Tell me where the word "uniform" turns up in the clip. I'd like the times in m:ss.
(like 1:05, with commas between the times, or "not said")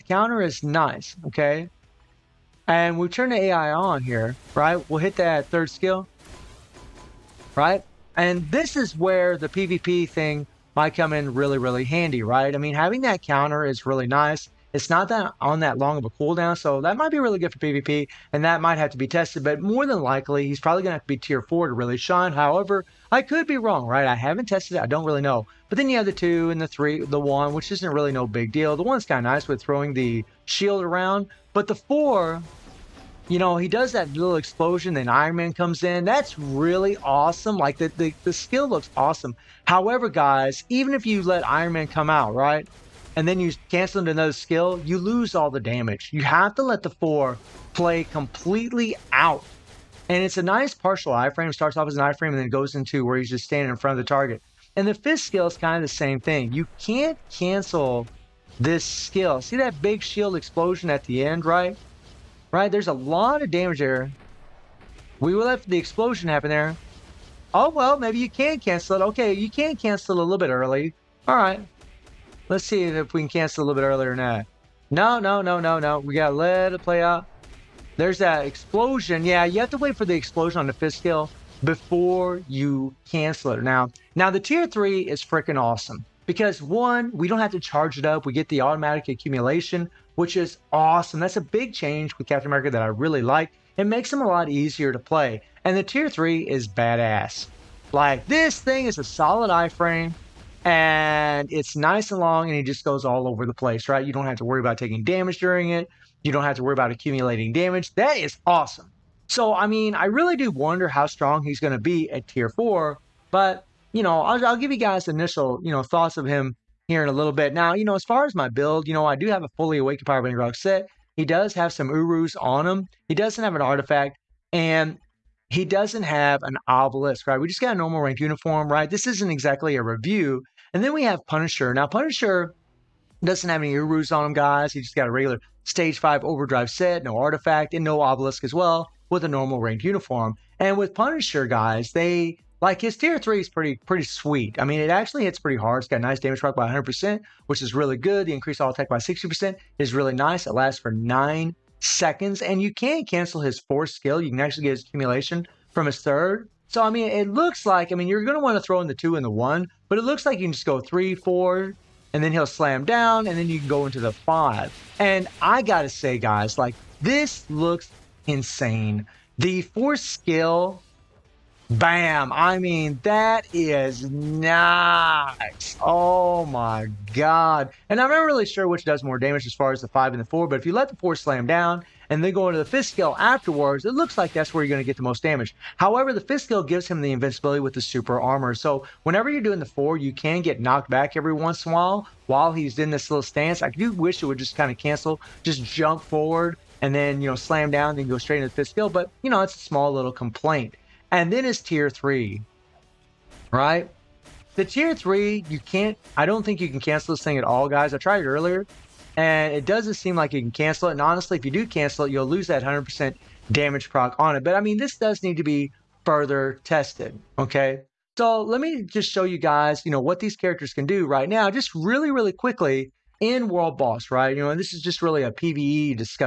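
2:08, 2:19.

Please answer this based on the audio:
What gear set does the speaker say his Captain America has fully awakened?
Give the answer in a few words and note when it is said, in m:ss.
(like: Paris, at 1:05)
Power Band Rock set, at 2:00.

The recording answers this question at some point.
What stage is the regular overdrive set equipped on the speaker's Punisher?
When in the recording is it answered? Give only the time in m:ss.
2:15.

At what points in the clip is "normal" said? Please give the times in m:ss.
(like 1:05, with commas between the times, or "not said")
2:07, 2:19.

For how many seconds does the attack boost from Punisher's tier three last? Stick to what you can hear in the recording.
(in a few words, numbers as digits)
9.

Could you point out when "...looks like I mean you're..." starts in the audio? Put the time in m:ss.
2:37.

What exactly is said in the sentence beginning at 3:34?
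But I mean, this does need to be further tested, okay?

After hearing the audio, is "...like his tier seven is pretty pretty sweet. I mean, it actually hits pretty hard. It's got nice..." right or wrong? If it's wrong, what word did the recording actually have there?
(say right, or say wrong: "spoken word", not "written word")
wrong: "three", not "seven".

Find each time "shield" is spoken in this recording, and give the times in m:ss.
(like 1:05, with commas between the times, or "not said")
0:30, 1:00.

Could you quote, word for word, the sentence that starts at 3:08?
So whenever you're doing the four, you can get knocked back every once in a while while he's in this little stance.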